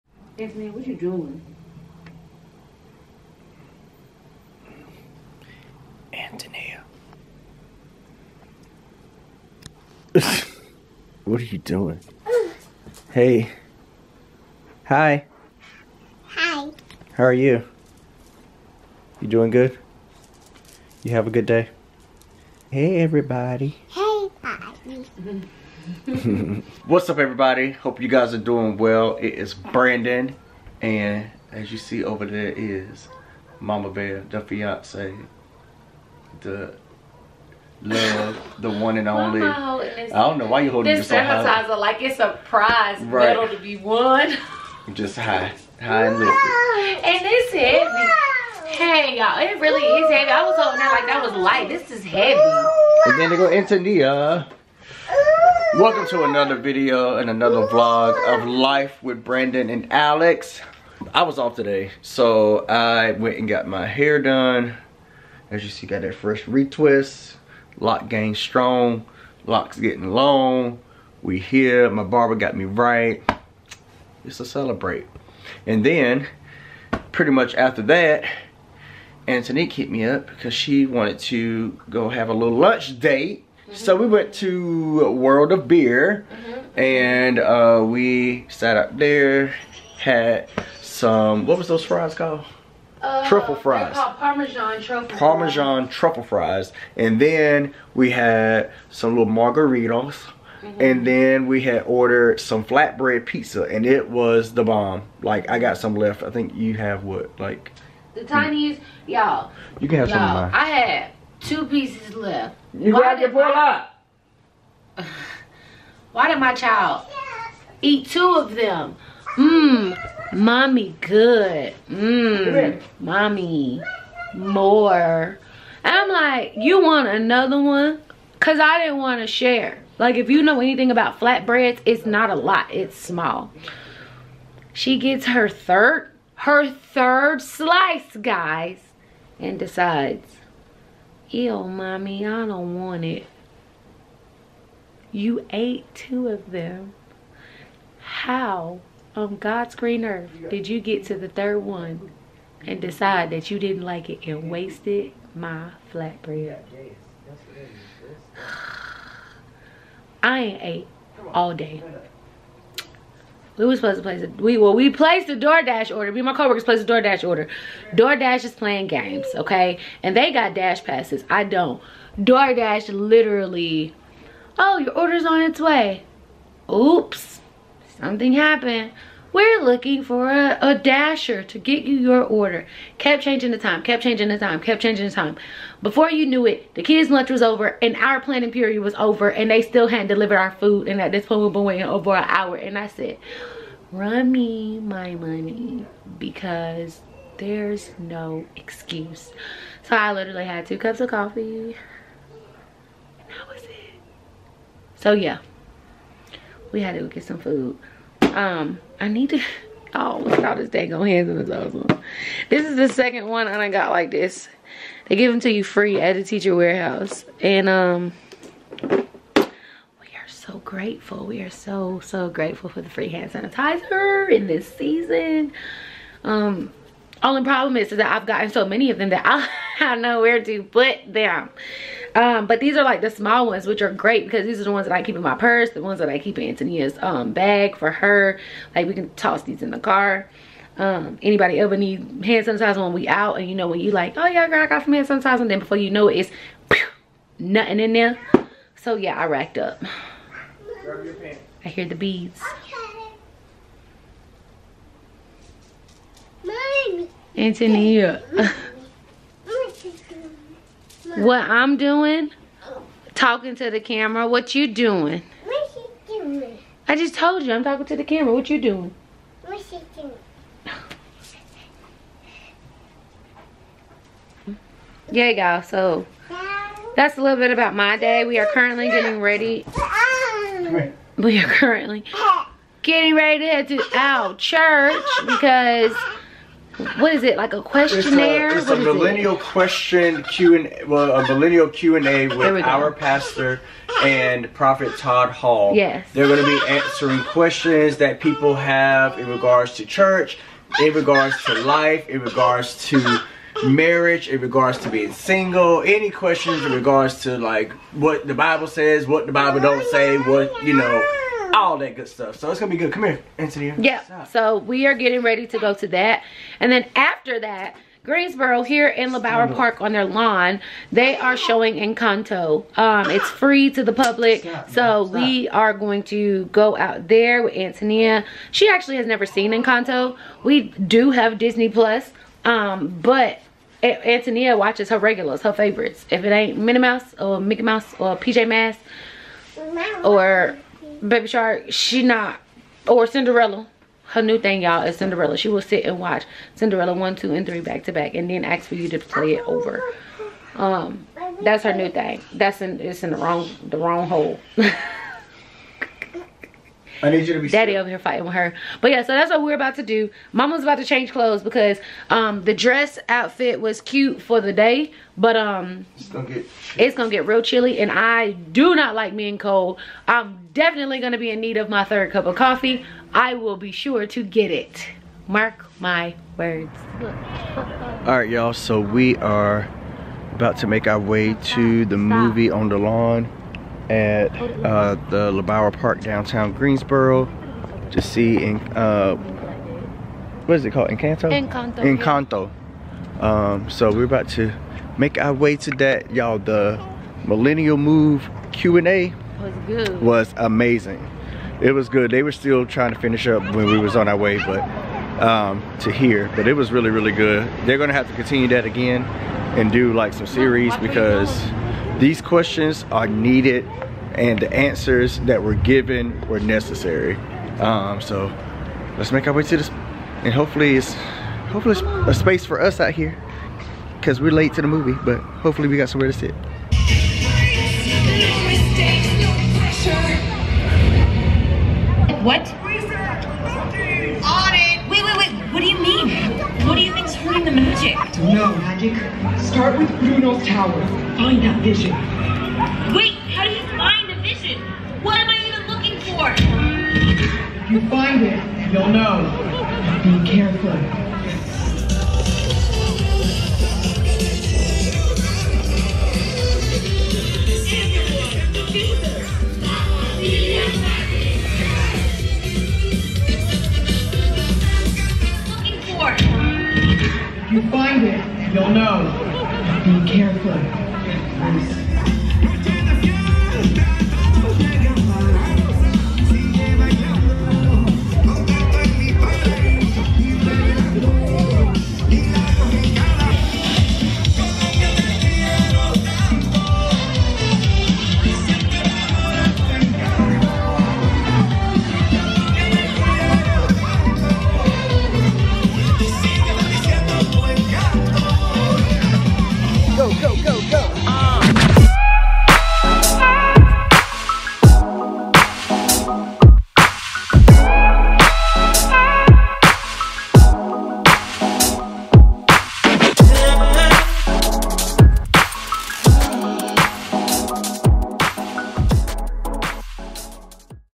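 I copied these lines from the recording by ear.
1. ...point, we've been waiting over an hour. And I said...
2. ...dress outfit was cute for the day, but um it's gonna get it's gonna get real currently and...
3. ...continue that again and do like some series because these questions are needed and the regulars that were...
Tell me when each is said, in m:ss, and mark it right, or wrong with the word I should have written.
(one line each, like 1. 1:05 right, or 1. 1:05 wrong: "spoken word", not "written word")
1. 3:11 right
2. 6:02 wrong: "chilly", not "currently"
3. 6:48 wrong: "answers", not "regulars".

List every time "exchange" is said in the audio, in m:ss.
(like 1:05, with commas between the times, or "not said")
not said.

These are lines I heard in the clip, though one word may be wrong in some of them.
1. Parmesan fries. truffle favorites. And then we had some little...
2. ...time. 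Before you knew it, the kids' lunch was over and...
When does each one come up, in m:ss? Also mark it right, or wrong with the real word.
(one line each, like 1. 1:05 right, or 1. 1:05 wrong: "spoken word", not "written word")
1. 1:35 wrong: "fries", not "favorites"
2. 3:05 right.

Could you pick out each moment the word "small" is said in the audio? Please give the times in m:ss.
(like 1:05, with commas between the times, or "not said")
2:12, 3:53.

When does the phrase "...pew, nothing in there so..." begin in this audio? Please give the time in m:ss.
4:06.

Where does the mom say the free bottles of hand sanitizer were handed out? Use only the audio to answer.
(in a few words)
The teacher warehouse.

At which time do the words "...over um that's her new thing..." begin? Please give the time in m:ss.
5:49.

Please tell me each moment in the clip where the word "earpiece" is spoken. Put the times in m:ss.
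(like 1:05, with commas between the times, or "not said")
not said.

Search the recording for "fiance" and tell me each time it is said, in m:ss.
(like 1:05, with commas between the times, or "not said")
0:34.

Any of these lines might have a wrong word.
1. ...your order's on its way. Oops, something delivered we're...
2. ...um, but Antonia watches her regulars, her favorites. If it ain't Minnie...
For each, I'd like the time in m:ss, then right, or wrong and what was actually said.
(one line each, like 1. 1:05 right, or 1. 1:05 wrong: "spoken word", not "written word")
1. 2:54 wrong: "happened", not "delivered"
2. 5:32 right.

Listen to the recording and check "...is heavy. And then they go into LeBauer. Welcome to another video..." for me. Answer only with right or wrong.
wrong.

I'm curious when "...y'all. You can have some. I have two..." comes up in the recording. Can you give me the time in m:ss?
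1:49.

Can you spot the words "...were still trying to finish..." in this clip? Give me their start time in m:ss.
6:42.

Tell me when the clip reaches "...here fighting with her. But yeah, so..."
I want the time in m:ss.
5:57.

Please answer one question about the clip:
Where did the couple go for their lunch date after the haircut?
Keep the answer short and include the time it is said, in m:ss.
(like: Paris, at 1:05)
World of Beer, at 1:25.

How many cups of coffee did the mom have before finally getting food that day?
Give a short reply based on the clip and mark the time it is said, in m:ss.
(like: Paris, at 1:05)
2, at 3:20.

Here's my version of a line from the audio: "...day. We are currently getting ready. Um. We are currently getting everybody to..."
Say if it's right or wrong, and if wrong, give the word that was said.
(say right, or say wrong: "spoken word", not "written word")
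wrong: "ready", not "everybody".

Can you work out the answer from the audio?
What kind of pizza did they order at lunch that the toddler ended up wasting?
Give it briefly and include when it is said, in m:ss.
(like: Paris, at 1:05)
Flatbread pizza, at 1:42.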